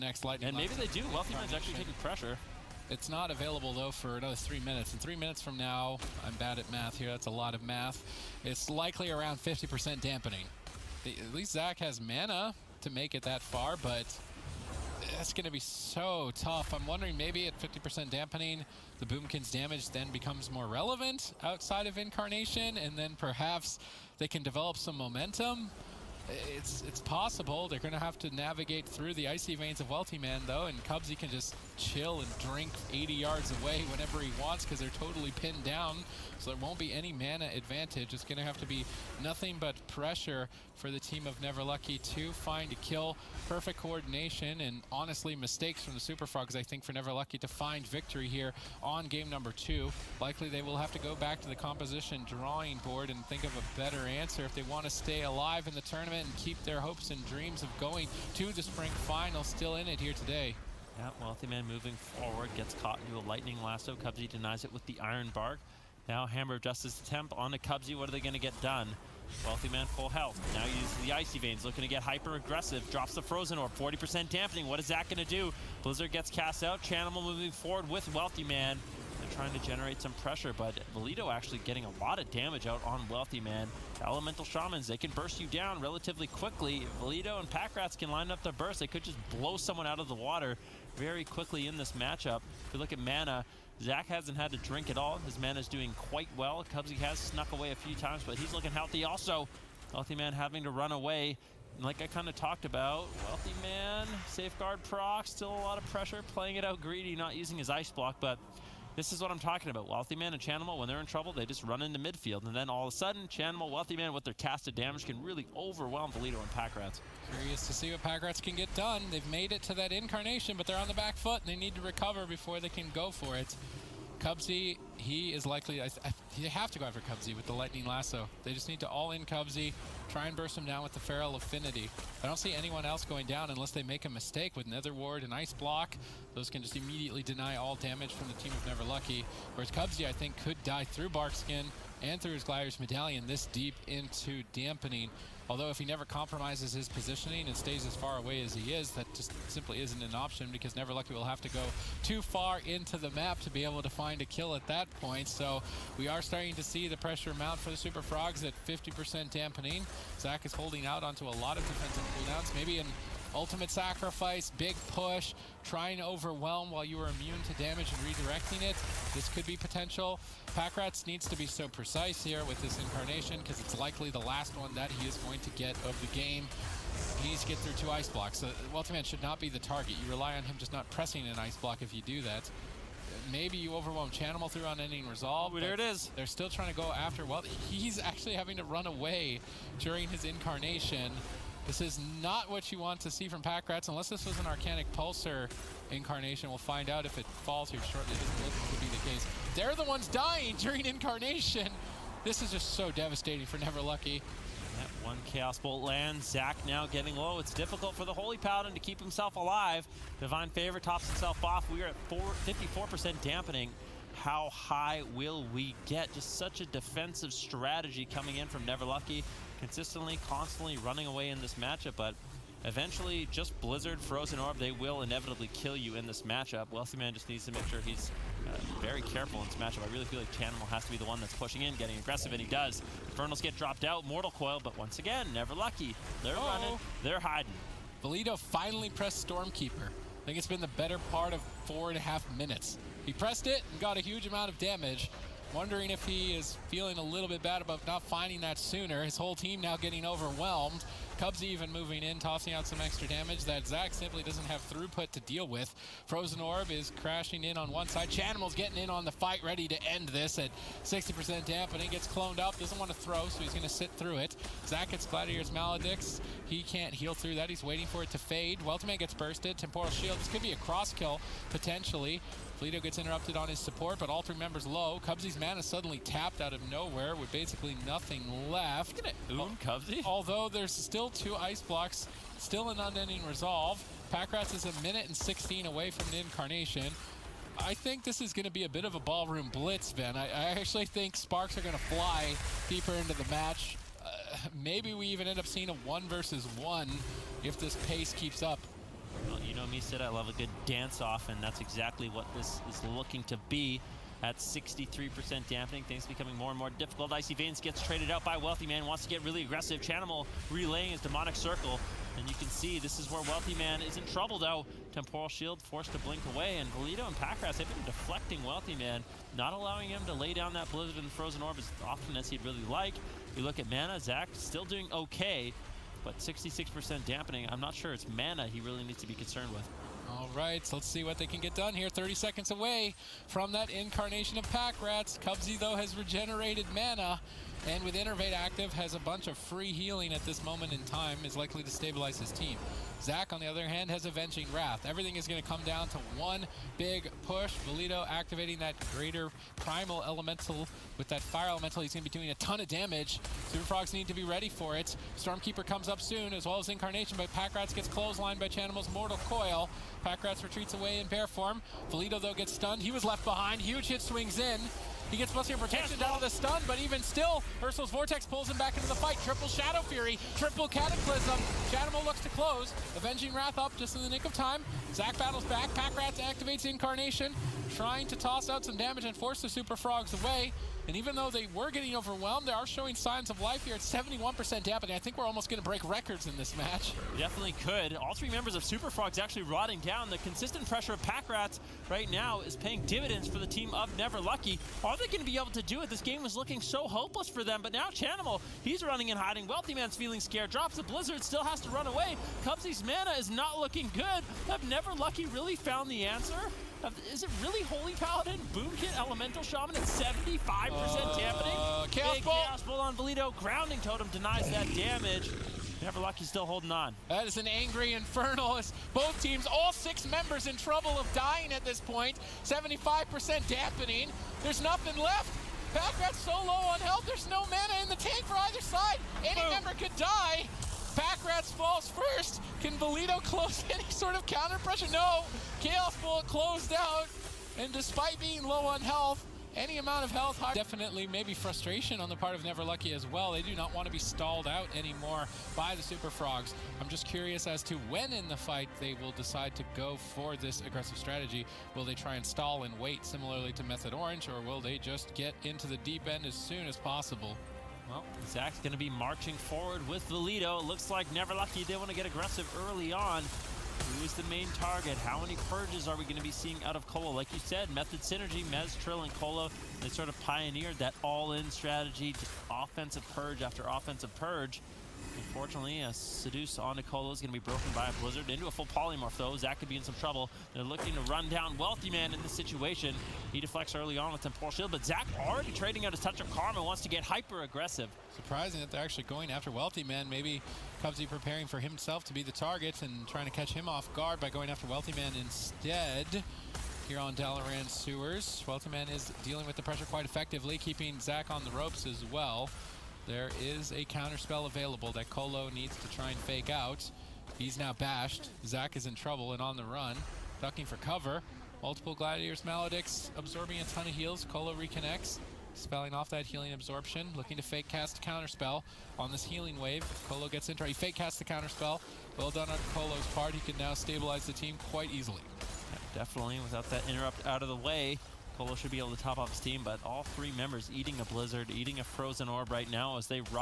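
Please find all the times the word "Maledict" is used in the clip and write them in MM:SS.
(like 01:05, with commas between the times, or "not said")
04:25, 08:32.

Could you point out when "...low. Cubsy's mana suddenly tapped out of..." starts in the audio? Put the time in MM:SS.
04:34.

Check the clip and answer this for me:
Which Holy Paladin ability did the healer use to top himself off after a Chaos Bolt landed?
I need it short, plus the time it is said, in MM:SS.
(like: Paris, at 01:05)
Divine Favor, at 03:30.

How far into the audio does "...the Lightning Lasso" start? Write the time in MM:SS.
02:07.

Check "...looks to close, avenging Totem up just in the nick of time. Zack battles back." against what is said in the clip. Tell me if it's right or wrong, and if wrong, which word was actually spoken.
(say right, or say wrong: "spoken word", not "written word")
wrong: "Wrath", not "Totem".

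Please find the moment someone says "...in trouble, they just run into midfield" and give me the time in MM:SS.
01:50.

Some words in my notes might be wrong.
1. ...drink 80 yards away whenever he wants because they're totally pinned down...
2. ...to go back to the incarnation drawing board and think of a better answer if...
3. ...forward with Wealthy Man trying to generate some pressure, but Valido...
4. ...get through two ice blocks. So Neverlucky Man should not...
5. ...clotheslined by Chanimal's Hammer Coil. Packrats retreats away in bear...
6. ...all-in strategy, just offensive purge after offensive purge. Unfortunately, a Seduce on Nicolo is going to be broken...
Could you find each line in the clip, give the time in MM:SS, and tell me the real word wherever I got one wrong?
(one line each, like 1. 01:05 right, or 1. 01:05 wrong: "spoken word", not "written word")
1. 00:32 right
2. 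00:50 wrong: "composition", not "incarnation"
3. 01:17 right
4. 02:57 wrong: "Wealthy", not "Neverlucky"
5. 05:57 wrong: "Mortal", not "Hammer"
6. 07:51 right.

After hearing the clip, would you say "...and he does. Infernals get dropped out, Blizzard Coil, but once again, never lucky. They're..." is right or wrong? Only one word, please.
wrong.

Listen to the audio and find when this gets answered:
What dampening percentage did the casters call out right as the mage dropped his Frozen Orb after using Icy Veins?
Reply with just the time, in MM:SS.
01:13.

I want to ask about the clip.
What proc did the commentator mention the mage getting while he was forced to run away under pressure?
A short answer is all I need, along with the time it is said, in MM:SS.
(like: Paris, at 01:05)
Safeguard, at 01:44.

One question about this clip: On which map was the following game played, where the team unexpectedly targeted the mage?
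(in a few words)
Dalaran Sewers.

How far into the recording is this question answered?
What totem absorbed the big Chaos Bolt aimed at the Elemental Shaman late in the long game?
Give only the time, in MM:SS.
06:53.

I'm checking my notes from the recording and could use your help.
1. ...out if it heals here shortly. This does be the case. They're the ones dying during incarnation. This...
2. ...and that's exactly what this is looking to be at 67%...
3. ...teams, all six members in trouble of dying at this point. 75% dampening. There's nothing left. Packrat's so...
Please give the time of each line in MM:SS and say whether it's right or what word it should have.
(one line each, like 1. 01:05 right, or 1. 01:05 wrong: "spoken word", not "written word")
1. 03:16 wrong: "falls", not "heals"
2. 05:01 wrong: "63", not "67"
3. 06:59 right.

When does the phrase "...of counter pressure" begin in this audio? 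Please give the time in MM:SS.
07:14.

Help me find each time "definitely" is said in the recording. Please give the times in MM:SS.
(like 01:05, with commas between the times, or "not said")
06:27, 07:20, 08:45.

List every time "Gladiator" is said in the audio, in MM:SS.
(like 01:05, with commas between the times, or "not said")
02:22, 04:25, 08:31.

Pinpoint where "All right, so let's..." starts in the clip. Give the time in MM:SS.
05:30.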